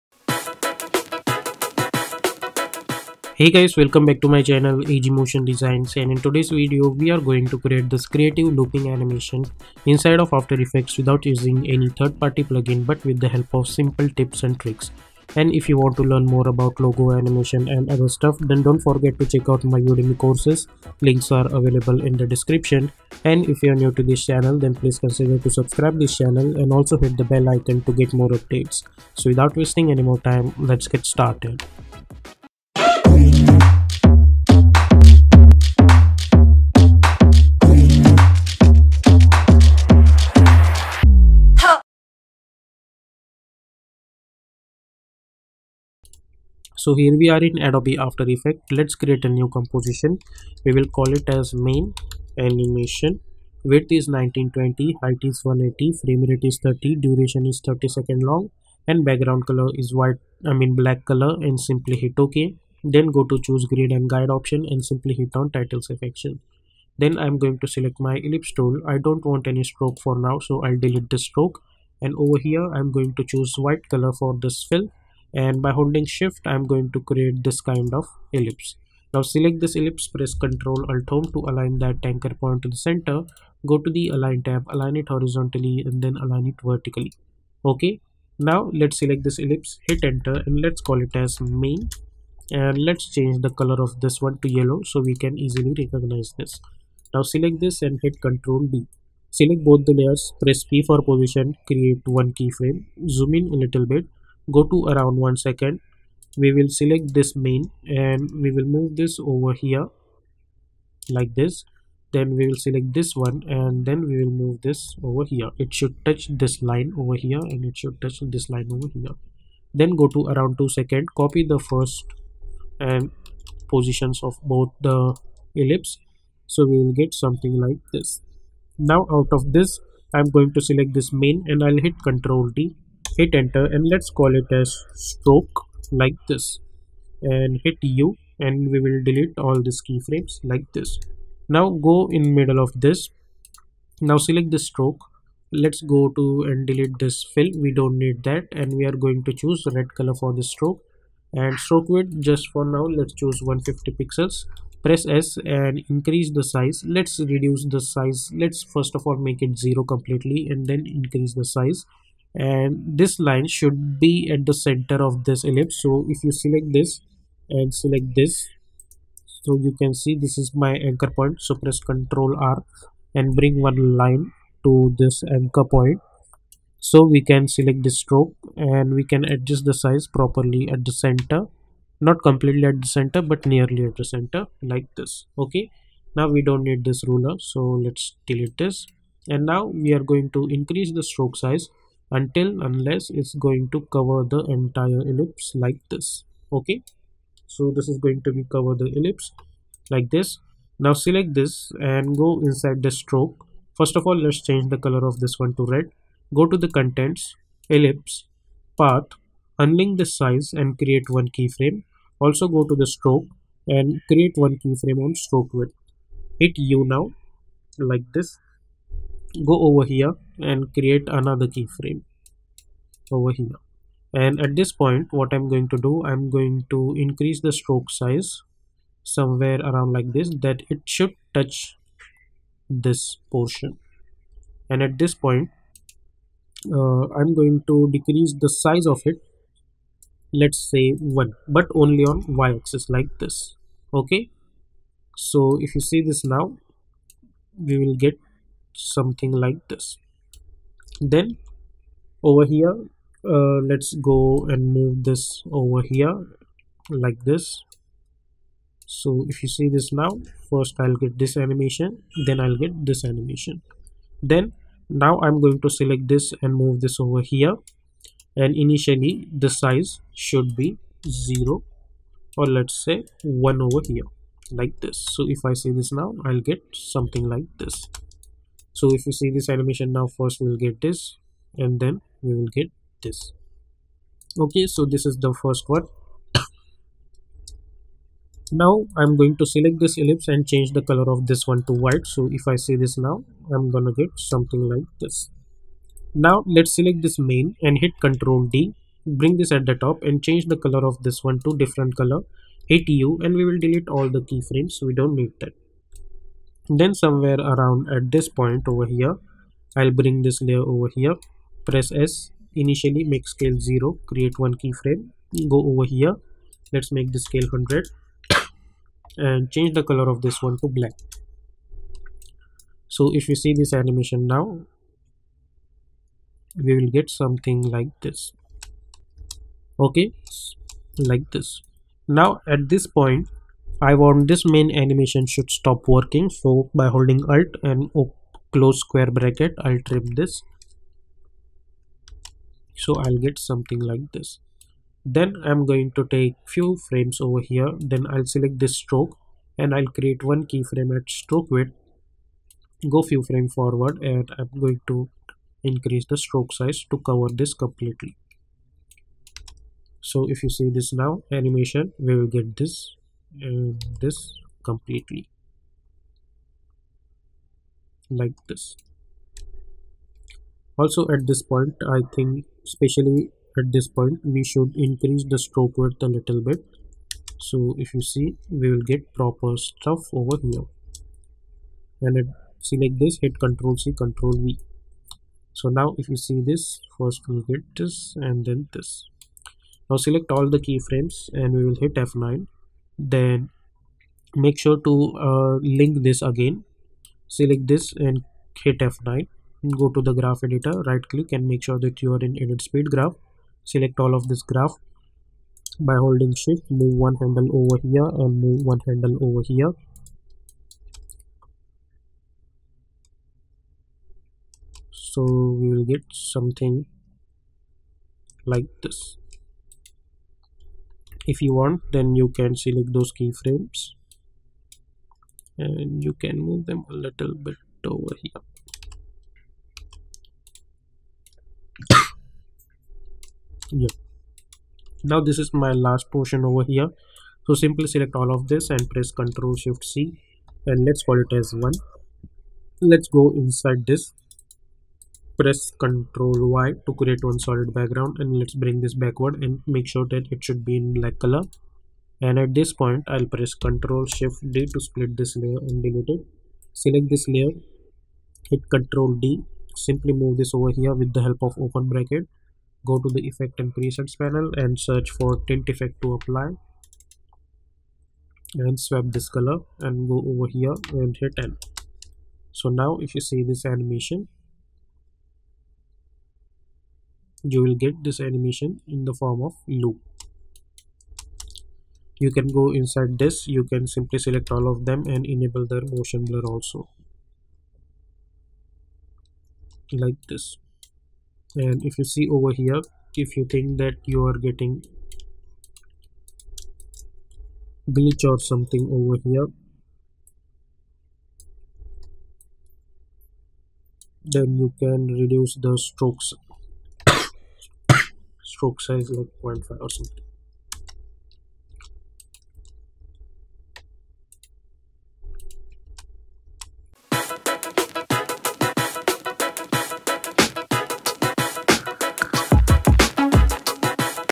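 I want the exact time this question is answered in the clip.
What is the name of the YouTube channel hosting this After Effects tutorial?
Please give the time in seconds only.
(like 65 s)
4 s.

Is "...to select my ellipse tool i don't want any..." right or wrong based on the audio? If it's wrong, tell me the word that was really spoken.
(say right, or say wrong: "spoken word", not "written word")
right.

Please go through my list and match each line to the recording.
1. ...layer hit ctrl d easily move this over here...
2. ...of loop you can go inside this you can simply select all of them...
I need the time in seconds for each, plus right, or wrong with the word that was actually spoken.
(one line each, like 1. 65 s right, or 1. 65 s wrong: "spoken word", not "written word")
1. 457 s wrong: "simply", not "easily"
2. 479 s right.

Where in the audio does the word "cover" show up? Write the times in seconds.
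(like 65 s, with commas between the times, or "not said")
193 s, 198 s, 356 s.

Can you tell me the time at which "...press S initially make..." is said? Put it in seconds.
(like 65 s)
311 s.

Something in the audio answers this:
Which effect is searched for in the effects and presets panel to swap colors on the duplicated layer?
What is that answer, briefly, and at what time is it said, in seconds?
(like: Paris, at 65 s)
tint, at 465 s.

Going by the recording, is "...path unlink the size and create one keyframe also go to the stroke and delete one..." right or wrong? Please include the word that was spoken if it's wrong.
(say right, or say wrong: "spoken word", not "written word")
wrong: "create", not "delete".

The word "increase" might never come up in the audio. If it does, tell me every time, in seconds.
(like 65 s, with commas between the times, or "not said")
155 s, 160 s, 190 s, 226 s, 355 s, 374 s.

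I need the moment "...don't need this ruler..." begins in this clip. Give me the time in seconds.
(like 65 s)
186 s.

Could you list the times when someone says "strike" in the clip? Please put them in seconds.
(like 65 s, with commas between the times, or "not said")
not said.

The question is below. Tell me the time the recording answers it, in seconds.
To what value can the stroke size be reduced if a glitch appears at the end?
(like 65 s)
509 s.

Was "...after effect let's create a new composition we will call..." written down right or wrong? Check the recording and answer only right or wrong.
right.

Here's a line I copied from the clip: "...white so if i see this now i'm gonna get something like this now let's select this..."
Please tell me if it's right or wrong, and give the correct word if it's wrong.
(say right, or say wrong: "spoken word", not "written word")
right.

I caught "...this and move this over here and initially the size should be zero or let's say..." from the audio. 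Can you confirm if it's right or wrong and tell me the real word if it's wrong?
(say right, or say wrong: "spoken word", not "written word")
right.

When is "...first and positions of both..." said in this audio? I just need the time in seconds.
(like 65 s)
121 s.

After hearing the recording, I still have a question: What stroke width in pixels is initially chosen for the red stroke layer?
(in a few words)
150.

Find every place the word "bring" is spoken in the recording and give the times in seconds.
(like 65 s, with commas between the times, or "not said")
173 s, 299 s, 309 s, 448 s.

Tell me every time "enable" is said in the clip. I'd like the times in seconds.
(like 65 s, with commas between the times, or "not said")
485 s.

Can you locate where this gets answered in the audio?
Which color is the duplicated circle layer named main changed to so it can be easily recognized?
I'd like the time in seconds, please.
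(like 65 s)
94 s.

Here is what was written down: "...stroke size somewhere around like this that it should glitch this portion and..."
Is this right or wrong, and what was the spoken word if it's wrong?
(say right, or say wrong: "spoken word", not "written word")
wrong: "touch", not "glitch".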